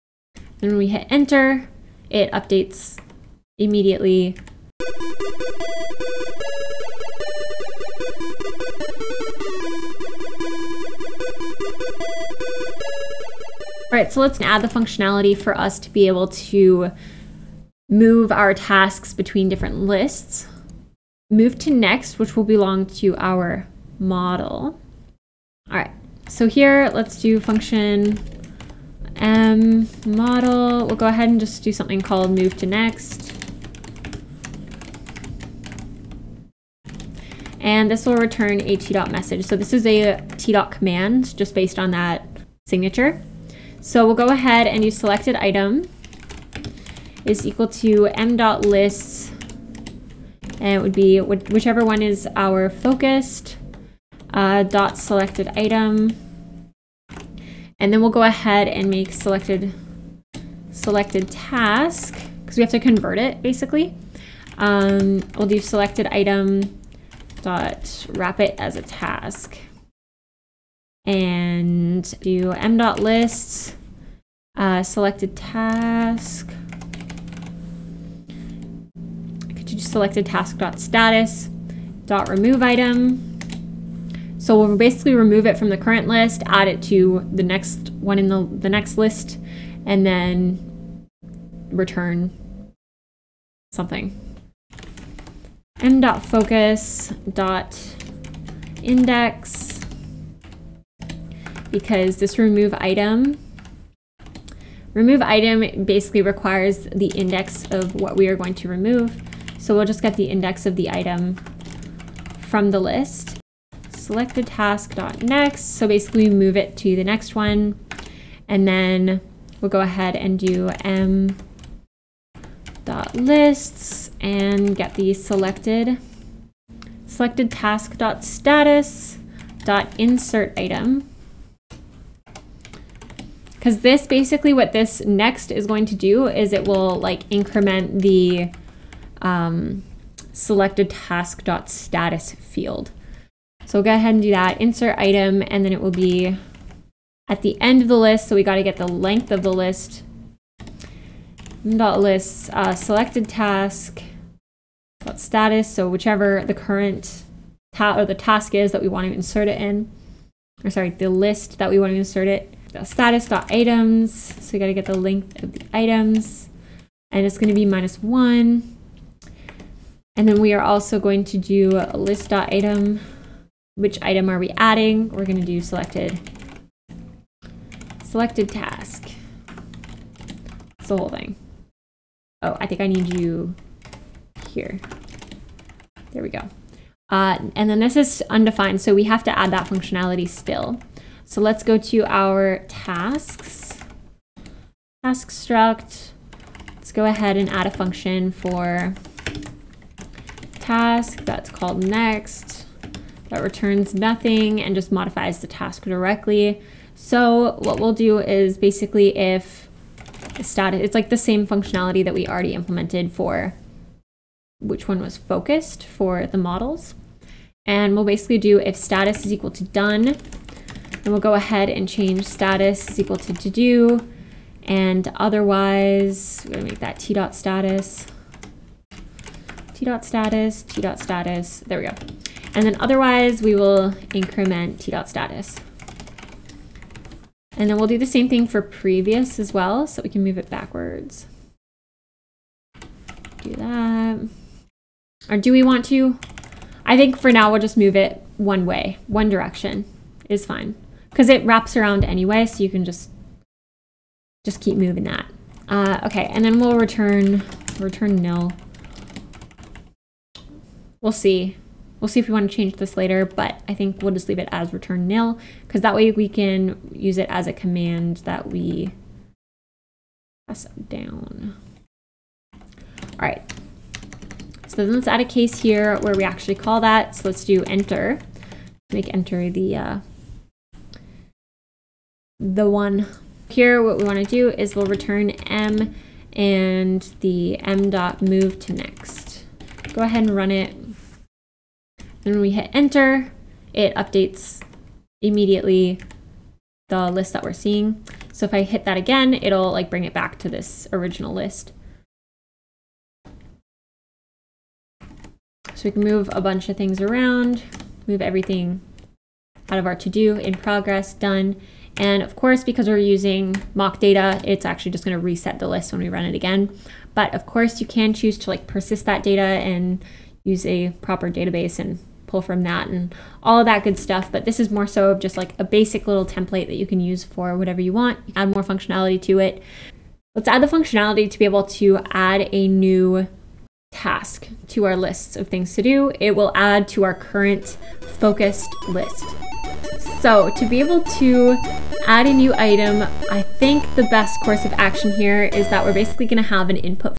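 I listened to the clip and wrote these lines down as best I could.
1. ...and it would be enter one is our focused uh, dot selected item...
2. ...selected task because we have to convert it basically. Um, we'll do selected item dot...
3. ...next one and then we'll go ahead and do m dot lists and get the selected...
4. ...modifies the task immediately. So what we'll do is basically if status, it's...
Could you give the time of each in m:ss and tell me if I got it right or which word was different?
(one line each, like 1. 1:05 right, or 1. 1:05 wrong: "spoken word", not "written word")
1. 0:50 wrong: "whichever", not "enter"
2. 1:00 right
3. 1:57 right
4. 3:24 wrong: "directly", not "immediately".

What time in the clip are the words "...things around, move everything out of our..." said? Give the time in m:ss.
5:06.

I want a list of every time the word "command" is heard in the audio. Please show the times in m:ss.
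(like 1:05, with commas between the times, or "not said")
0:40, 4:27.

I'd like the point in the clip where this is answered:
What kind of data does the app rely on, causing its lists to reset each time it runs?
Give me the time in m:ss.
5:13.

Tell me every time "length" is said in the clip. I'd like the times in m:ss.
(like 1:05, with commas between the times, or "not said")
2:28, 2:44.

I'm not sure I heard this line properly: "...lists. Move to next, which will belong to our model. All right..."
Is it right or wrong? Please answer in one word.
right.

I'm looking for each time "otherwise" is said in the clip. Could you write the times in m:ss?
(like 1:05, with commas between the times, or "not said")
3:45, 3:52.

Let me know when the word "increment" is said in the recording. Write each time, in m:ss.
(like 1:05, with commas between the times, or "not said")
2:17, 3:54.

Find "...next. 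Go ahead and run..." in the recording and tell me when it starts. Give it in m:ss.
4:48.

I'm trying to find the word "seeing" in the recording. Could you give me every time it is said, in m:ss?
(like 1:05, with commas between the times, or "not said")
4:57.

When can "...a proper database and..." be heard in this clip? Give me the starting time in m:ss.
5:20.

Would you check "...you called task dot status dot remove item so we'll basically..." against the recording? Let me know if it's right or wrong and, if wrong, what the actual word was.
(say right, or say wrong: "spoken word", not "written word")
wrong: "selected", not "called".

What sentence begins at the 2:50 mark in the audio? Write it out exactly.
And then we are also going to do list dot item which item are we adding?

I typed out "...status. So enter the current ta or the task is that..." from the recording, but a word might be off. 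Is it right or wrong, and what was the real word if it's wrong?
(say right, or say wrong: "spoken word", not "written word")
wrong: "whichever", not "enter".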